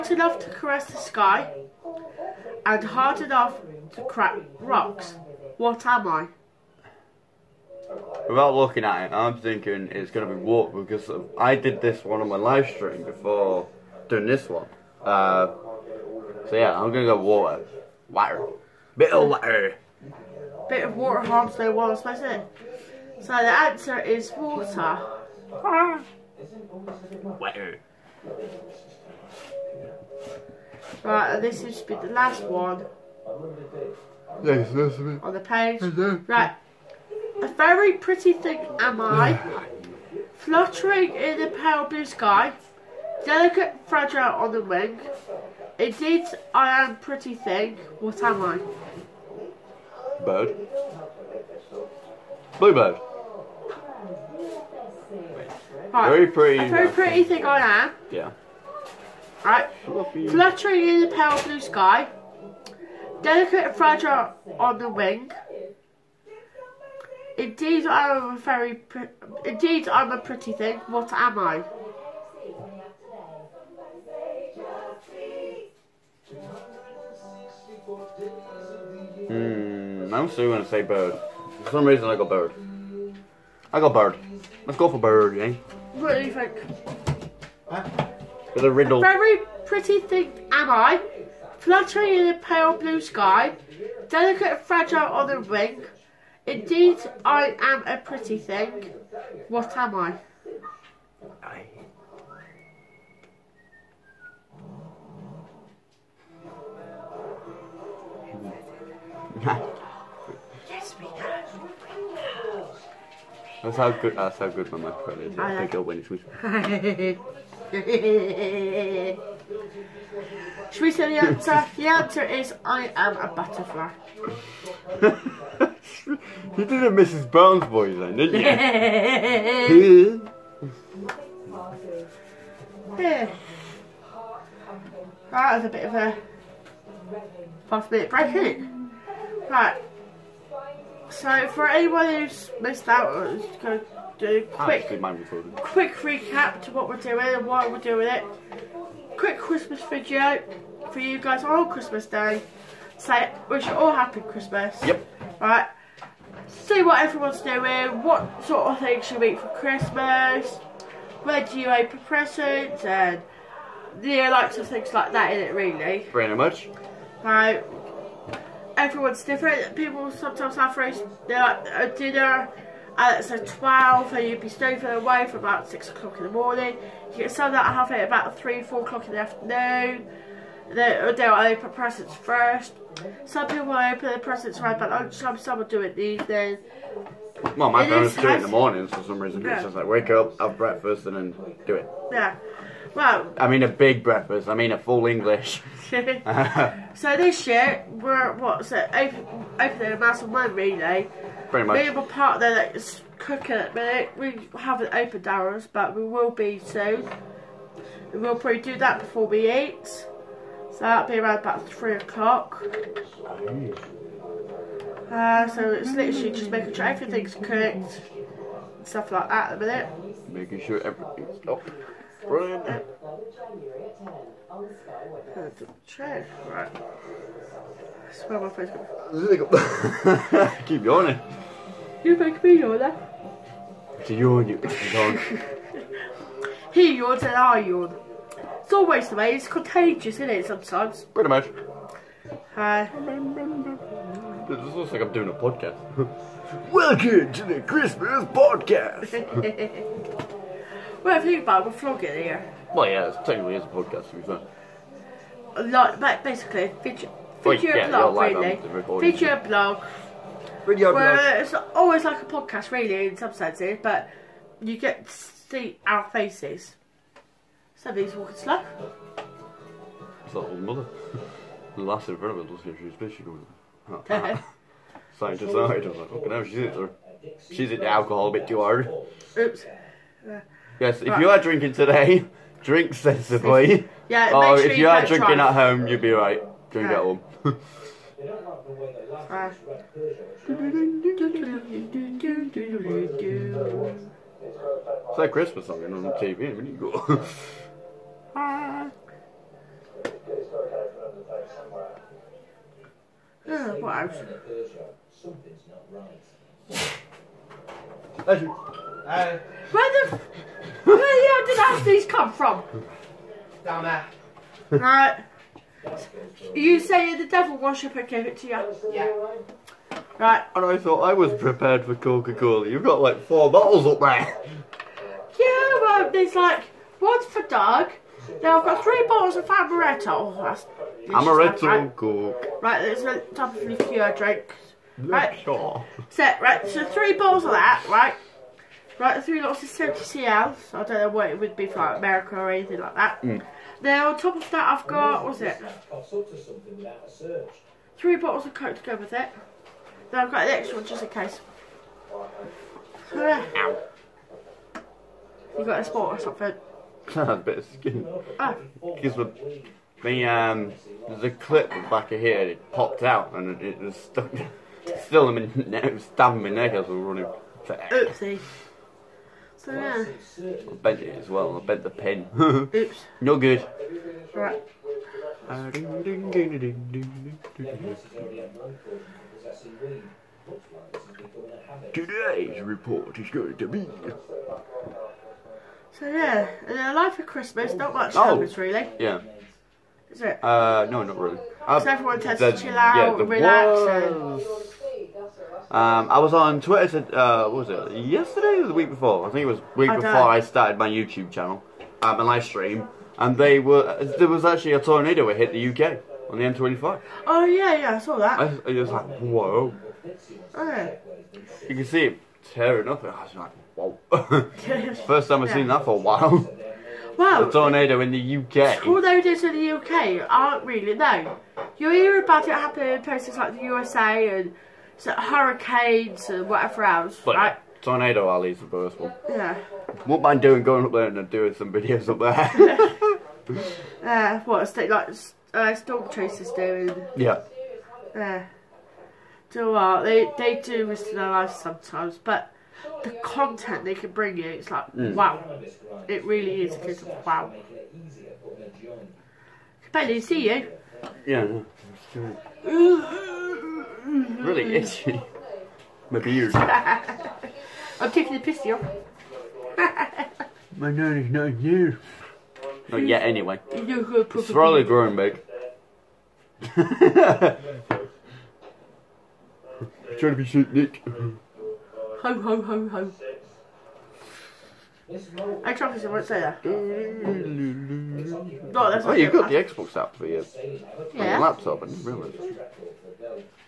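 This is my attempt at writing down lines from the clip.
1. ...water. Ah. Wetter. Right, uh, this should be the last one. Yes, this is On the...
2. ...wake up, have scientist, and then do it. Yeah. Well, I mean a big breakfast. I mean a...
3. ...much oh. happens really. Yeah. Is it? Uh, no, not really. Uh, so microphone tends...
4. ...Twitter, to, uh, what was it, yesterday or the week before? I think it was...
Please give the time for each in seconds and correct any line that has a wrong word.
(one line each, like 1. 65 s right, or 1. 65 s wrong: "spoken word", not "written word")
1. 24 s right
2. 189 s wrong: "breakfast", not "scientist"
3. 387 s wrong: "everyone", not "microphone"
4. 396 s right.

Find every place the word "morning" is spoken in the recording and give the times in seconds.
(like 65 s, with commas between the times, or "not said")
176 s, 188 s.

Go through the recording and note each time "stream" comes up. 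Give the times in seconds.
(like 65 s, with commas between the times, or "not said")
12 s, 402 s.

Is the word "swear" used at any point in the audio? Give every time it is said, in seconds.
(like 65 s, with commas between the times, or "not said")
228 s.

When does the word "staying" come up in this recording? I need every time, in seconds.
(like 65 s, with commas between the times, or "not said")
174 s.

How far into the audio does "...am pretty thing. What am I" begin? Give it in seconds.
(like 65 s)
46 s.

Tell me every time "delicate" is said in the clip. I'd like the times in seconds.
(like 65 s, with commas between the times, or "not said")
43 s, 63 s, 94 s.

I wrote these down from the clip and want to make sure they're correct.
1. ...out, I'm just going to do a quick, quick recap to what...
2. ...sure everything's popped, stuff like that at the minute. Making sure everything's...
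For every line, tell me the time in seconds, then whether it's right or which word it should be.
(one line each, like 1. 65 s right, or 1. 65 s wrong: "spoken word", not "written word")
1. 142 s right
2. 216 s wrong: "cooked", not "popped".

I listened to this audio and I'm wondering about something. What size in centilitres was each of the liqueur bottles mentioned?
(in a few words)
70 CL.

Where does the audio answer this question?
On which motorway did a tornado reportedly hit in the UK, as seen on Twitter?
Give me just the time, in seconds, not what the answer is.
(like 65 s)
406 s.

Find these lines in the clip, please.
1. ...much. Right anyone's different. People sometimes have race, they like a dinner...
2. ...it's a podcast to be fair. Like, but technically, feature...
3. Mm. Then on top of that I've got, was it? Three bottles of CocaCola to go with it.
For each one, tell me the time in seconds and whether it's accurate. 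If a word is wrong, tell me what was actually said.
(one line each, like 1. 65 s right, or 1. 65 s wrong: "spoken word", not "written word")
1. 166 s wrong: "everyone", not "anyone"
2. 253 s wrong: "basically", not "technically"
3. 343 s wrong: "Coke", not "CocaCola".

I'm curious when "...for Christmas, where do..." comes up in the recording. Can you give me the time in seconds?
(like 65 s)
159 s.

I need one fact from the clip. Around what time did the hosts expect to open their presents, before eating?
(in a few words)
3 o'clock.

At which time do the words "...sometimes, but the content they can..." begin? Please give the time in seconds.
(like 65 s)
441 s.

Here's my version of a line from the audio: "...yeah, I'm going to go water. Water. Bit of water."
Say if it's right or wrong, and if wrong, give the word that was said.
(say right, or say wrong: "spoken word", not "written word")
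right.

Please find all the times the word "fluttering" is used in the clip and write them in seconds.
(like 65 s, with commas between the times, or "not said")
40 s, 59 s, 91 s.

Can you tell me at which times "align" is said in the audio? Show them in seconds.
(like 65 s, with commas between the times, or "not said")
not said.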